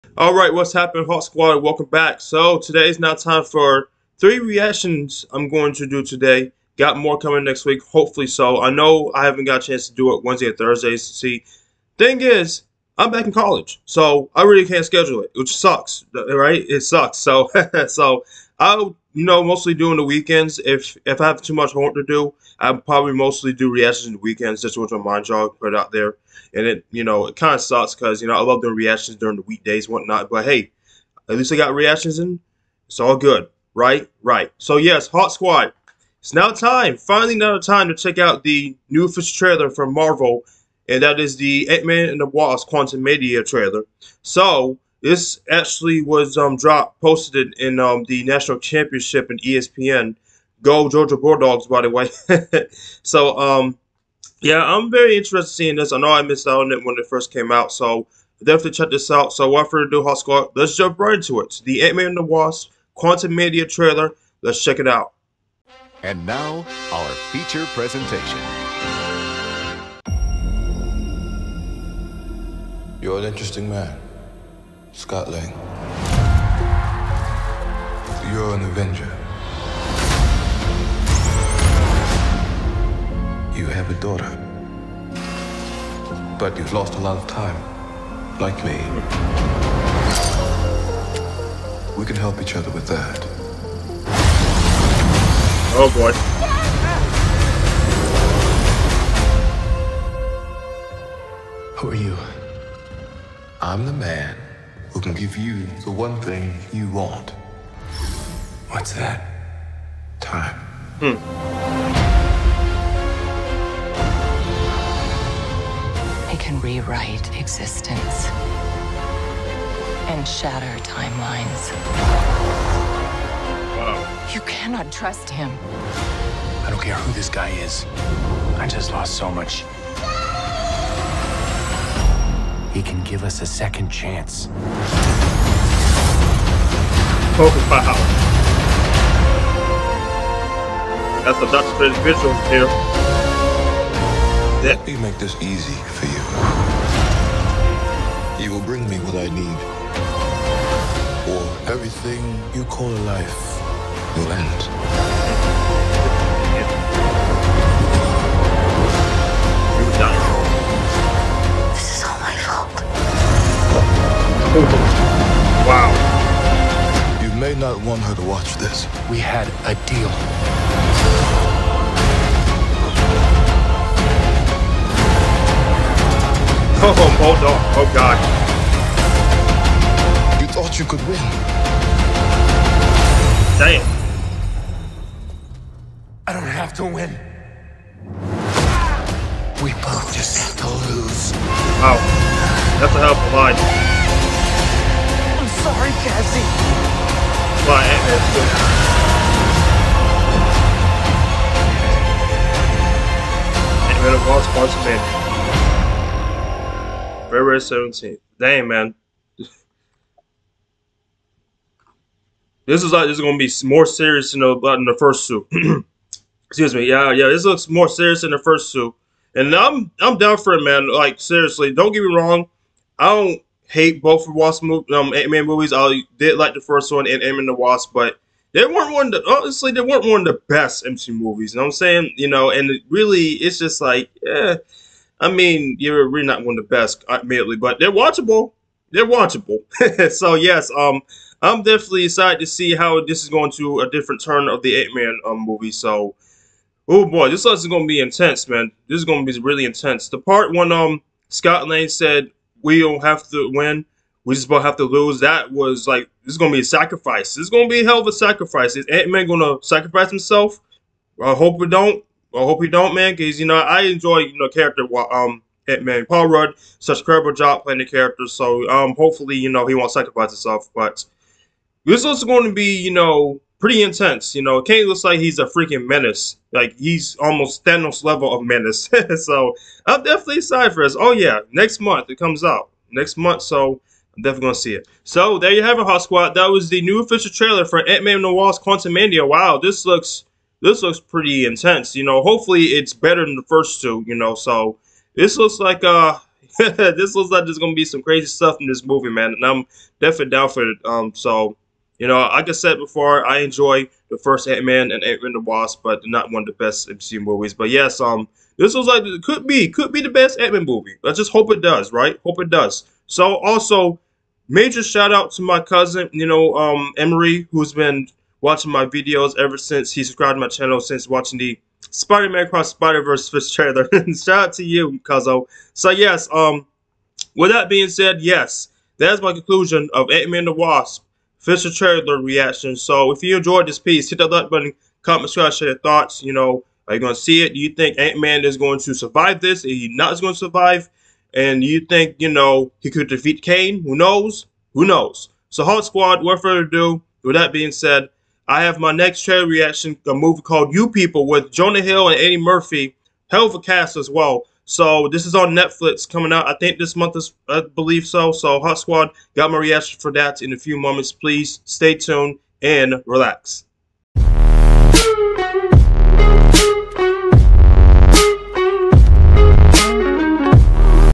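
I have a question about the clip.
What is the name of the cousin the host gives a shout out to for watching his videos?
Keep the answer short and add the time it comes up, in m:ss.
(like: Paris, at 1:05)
Emery, at 5:16.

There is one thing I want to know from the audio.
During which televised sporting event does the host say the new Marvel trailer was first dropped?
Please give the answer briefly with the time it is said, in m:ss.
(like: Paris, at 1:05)
the national championship, at 0:48.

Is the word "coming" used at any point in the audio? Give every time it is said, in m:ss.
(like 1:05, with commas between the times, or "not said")
0:07, 5:56.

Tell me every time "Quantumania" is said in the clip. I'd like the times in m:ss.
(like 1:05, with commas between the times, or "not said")
0:42, 1:02, 4:48.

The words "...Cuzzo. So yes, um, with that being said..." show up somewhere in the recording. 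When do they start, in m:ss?
5:25.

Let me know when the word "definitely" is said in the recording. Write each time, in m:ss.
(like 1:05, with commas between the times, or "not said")
0:58, 4:01, 4:40, 4:44, 5:00.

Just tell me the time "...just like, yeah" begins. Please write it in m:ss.
3:53.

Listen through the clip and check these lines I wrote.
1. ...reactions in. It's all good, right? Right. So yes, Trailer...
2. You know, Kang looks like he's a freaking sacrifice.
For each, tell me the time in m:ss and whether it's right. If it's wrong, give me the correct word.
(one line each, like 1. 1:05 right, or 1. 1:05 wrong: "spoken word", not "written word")
1. 0:31 wrong: "Hawk", not "Trailer"
2. 4:34 wrong: "menace", not "sacrifice".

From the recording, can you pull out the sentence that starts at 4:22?
I hope he don't, man, because you know I enjoy you know character um Ant Man.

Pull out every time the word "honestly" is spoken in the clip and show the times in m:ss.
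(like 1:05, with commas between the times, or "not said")
3:49.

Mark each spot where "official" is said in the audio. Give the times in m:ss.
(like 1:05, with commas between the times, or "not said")
0:39, 4:47.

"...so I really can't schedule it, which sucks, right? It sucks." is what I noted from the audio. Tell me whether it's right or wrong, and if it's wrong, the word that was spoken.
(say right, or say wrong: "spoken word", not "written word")
right.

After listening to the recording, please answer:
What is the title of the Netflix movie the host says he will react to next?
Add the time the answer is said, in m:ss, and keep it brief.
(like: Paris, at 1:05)
You People, at 5:50.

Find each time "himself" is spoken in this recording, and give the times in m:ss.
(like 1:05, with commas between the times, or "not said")
4:20, 4:30.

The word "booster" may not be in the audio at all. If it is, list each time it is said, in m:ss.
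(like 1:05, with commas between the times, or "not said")
not said.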